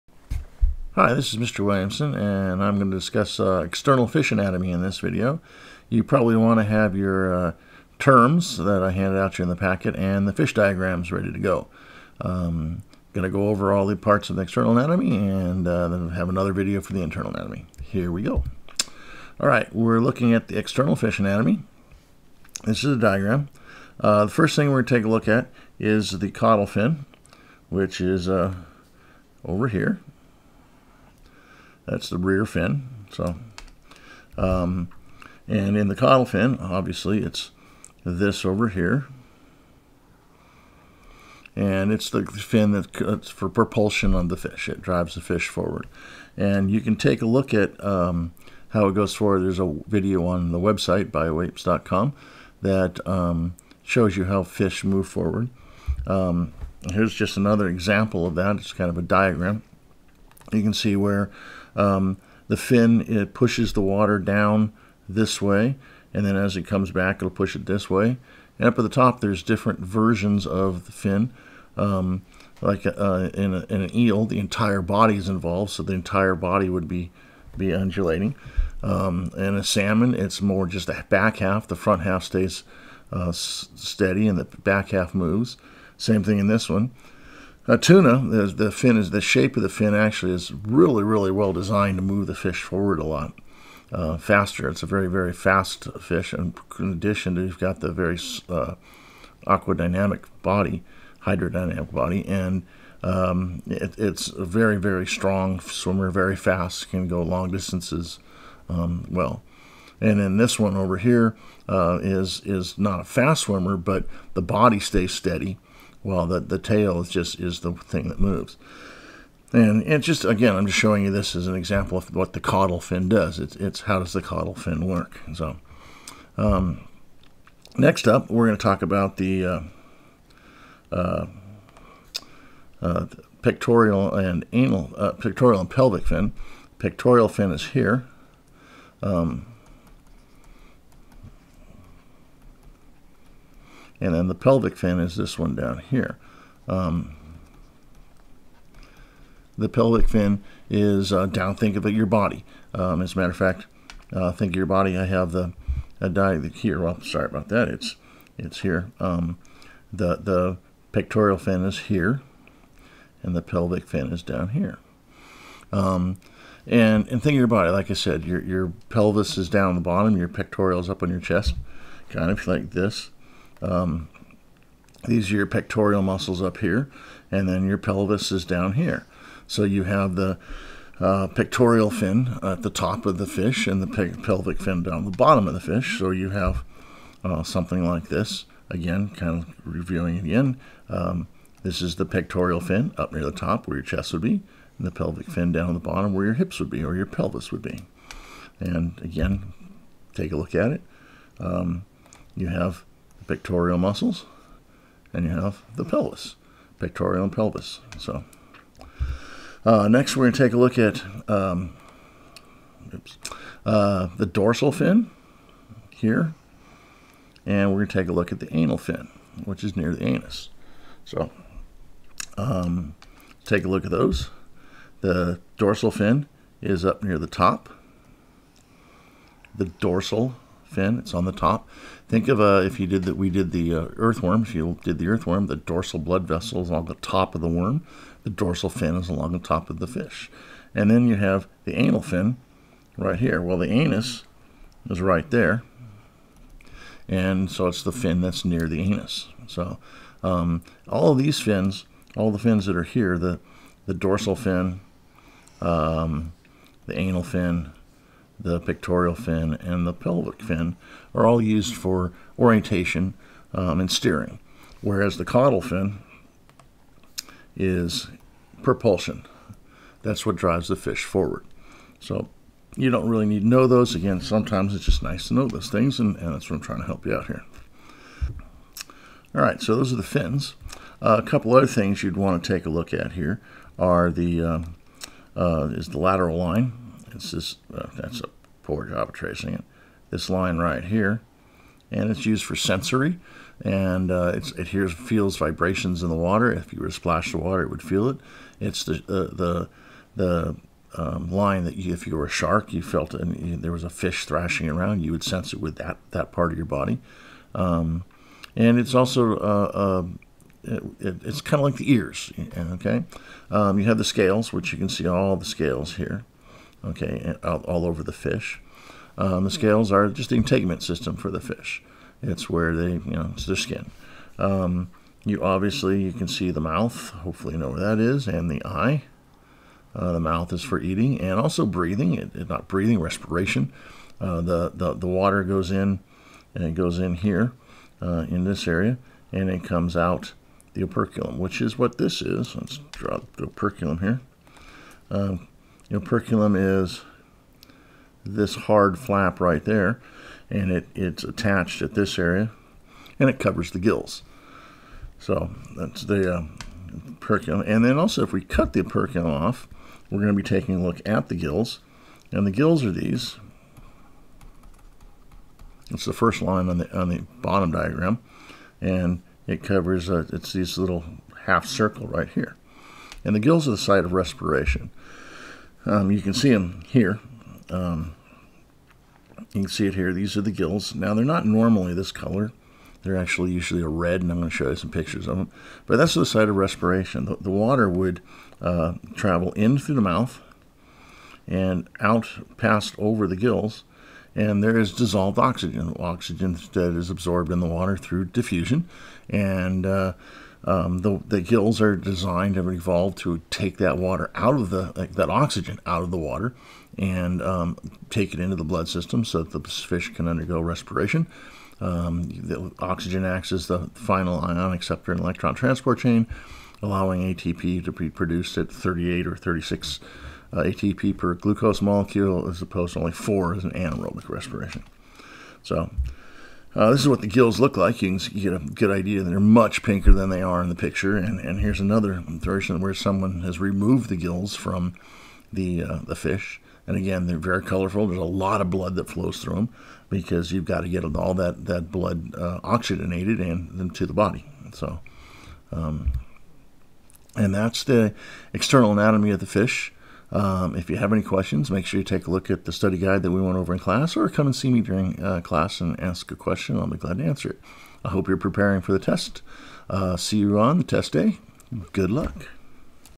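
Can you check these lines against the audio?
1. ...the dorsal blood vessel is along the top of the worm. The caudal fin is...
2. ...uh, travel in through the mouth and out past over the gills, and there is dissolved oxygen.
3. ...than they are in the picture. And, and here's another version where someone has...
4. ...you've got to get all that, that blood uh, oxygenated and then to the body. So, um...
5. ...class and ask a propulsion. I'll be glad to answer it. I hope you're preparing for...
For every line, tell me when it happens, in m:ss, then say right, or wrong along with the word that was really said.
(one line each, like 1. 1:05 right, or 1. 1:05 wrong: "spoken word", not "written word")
1. 3:55 wrong: "dorsal", not "caudal"
2. 6:28 right
3. 7:10 right
4. 7:20 right
5. 7:35 wrong: "question", not "propulsion".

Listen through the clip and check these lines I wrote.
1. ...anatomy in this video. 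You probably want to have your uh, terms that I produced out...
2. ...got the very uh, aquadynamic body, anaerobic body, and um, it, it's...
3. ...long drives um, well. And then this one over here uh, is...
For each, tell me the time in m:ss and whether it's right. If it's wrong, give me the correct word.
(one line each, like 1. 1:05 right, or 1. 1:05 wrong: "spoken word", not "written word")
1. 0:04 wrong: "handed", not "produced"
2. 1:37 wrong: "hydrodynamic", not "anaerobic"
3. 1:47 wrong: "distances", not "drives".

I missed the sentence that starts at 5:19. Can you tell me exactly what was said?
Um, the scales are just the integument system for the fish.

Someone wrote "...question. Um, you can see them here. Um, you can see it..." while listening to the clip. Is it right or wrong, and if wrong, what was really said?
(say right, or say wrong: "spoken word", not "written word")
wrong: "respiration", not "question".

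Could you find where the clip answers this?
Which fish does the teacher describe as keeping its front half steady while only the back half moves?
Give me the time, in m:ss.
1:19.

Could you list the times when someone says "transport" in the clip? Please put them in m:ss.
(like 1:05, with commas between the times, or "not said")
6:55.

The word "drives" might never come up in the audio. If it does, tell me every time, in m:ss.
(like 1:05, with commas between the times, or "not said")
0:44, 4:30.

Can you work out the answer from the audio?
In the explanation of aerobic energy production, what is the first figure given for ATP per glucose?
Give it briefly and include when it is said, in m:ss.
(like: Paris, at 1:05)
38, at 6:58.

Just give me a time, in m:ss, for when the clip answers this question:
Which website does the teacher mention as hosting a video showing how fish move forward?
0:51.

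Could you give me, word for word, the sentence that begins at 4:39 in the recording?
All right, so those are the fins.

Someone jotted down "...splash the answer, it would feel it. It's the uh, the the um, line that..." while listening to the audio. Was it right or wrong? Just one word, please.
wrong.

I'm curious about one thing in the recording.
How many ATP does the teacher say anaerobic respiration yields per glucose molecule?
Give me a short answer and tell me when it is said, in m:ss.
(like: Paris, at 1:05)
4, at 7:03.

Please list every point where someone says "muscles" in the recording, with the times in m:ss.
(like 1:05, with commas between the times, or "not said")
2:56, 3:23.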